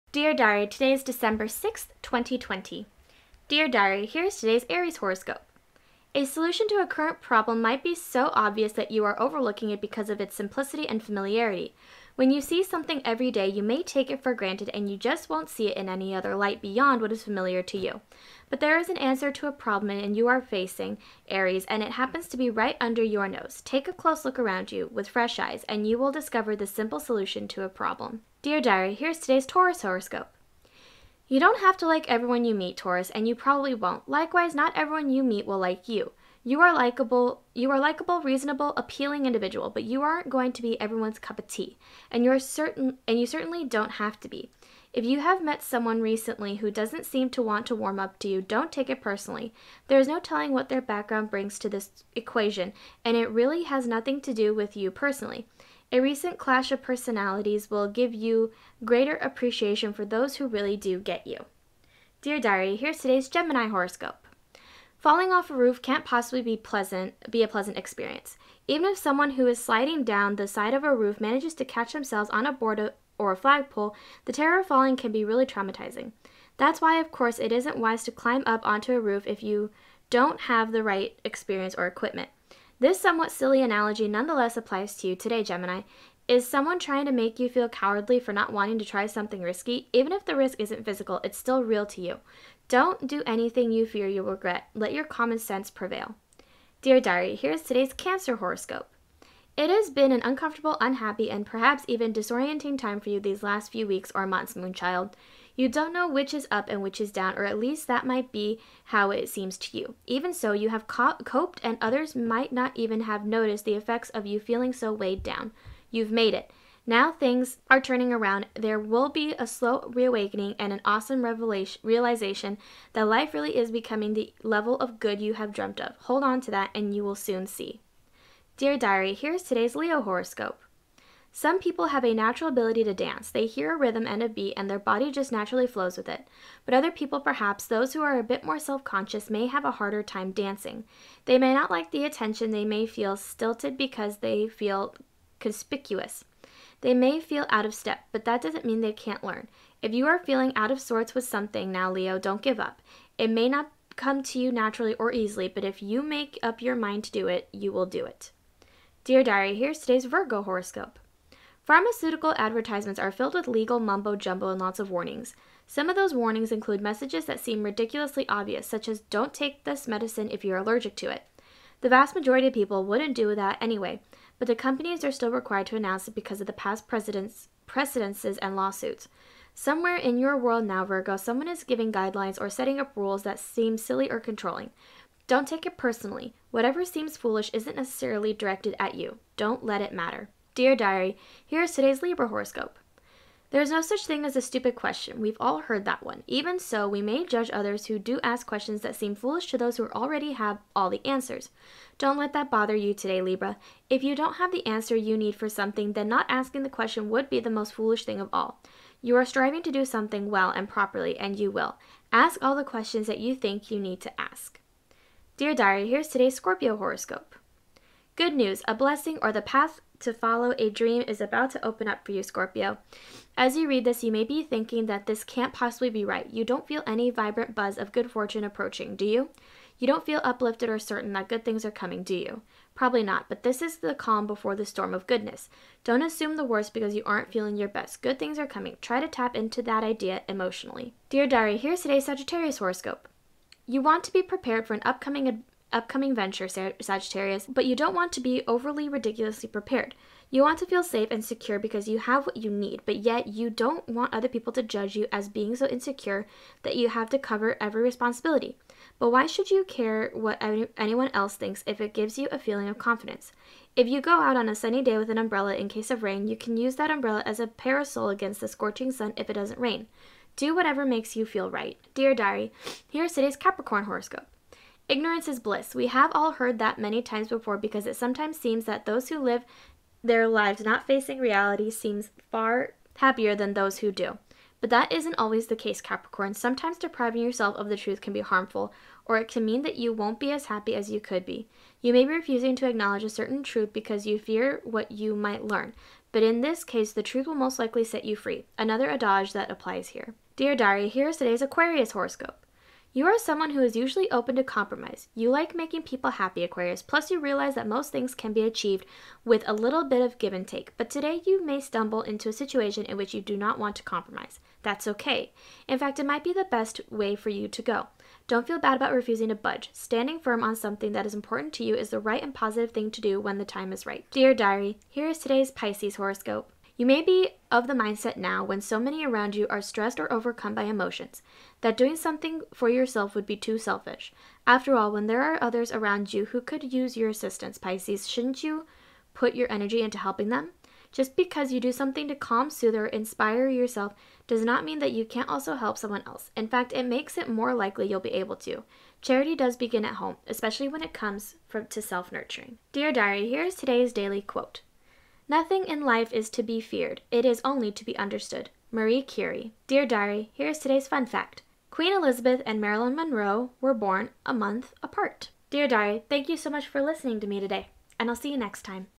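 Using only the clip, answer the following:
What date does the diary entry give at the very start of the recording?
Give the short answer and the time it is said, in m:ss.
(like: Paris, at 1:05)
December 6th, 2020, at 0:01.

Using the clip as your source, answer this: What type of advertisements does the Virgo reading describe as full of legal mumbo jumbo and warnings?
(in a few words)
Pharmaceutical advertisements.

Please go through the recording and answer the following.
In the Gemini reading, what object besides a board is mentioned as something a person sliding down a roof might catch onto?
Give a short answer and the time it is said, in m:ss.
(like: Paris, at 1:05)
A flagpole, at 1:13.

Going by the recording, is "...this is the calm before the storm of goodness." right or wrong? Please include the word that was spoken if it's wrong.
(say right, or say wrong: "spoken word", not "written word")
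right.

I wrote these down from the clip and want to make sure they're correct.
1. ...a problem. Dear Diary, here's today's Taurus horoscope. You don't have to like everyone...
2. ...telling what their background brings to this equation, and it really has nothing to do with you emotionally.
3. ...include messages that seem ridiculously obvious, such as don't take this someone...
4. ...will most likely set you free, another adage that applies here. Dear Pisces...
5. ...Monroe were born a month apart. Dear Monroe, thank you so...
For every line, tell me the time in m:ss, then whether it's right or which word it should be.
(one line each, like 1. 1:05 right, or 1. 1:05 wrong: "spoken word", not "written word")
1. 0:27 right
2. 0:50 wrong: "personally", not "emotionally"
3. 2:46 wrong: "medicine", not "someone"
4. 4:57 wrong: "Diary", not "Pisces"
5. 6:02 wrong: "Diary", not "Monroe".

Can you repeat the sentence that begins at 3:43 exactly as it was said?
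As you read this, you may be thinking that this can't possibly be right.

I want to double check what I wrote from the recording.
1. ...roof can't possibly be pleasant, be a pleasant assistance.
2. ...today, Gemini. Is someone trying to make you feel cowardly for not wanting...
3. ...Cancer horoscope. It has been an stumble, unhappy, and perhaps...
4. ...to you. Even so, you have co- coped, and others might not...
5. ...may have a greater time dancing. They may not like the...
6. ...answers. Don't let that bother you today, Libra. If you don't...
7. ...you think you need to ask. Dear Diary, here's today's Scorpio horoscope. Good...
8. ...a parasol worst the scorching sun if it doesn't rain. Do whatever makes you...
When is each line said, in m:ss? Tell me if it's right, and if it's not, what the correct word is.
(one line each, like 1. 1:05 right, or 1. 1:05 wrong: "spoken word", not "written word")
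1. 1:05 wrong: "experience", not "assistance"
2. 1:25 right
3. 1:37 wrong: "uncomfortable", not "stumble"
4. 1:49 right
5. 2:19 wrong: "harder", not "greater"
6. 3:21 right
7. 3:33 right
8. 4:27 wrong: "against", not "worst".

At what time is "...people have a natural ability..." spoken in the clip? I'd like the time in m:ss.
2:11.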